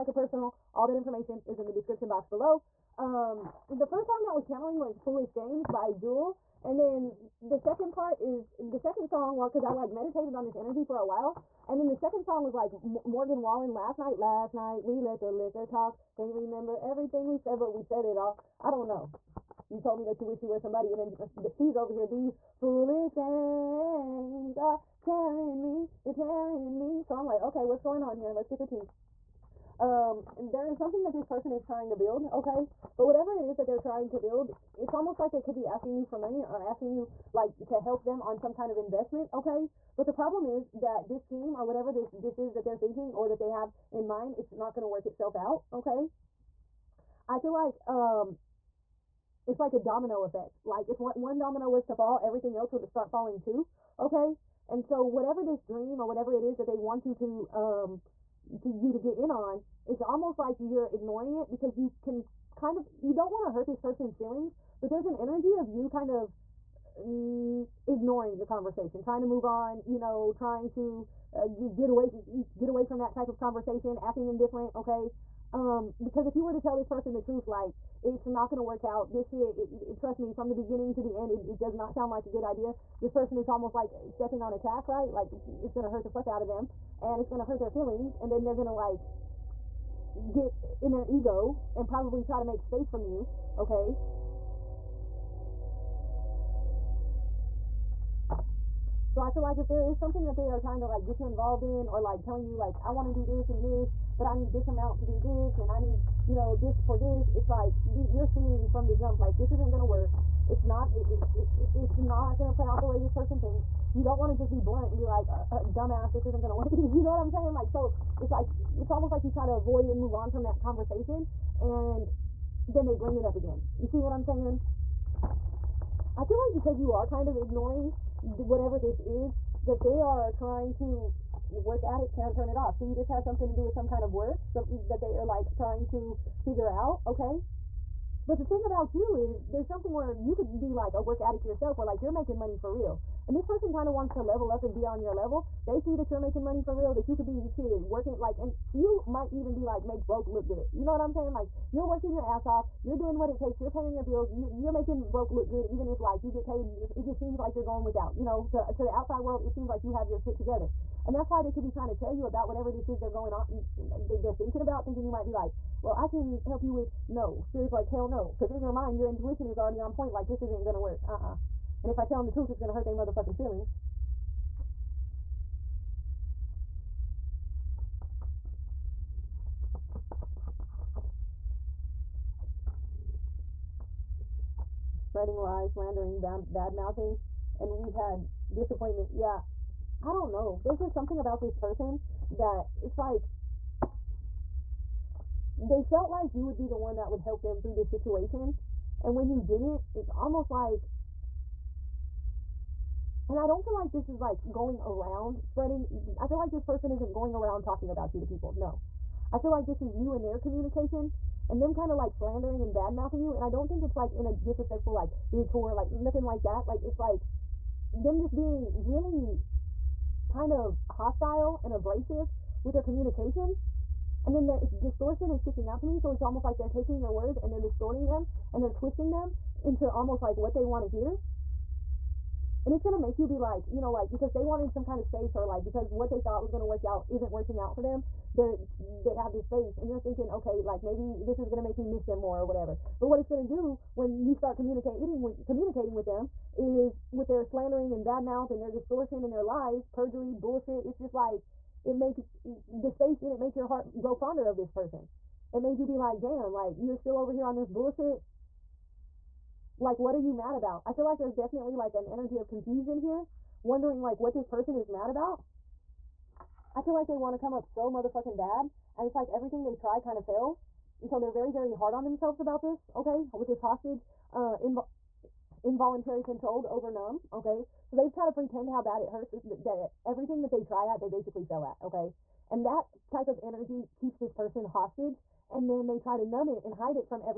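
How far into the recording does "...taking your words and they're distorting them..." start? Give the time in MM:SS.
03:46.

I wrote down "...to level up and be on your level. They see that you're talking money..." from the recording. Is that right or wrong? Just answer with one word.
wrong.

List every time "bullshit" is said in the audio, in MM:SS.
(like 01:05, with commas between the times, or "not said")
04:10, 04:17.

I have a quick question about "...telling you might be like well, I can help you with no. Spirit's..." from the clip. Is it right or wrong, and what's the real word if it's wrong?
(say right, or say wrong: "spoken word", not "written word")
wrong: "thinking", not "telling".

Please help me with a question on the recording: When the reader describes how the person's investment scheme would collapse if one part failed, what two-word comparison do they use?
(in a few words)
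domino effect.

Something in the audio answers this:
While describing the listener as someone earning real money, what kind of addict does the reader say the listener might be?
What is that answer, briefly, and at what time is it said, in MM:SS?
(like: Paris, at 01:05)
work addict, at 02:21.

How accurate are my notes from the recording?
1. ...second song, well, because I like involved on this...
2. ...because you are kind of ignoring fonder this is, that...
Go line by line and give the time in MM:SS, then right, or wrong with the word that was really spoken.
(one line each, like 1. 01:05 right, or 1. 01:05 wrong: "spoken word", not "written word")
1. 00:08 wrong: "meditated", not "involved"
2. 02:06 wrong: "whatever", not "fonder".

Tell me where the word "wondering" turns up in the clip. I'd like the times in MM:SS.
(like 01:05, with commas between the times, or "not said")
04:23.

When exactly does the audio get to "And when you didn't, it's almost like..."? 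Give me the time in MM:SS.
03:19.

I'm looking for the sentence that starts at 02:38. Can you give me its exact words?
You know, to to the outside world it seems like you have your shit together.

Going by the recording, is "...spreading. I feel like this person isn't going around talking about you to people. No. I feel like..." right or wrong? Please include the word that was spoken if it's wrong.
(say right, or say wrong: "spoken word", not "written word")
right.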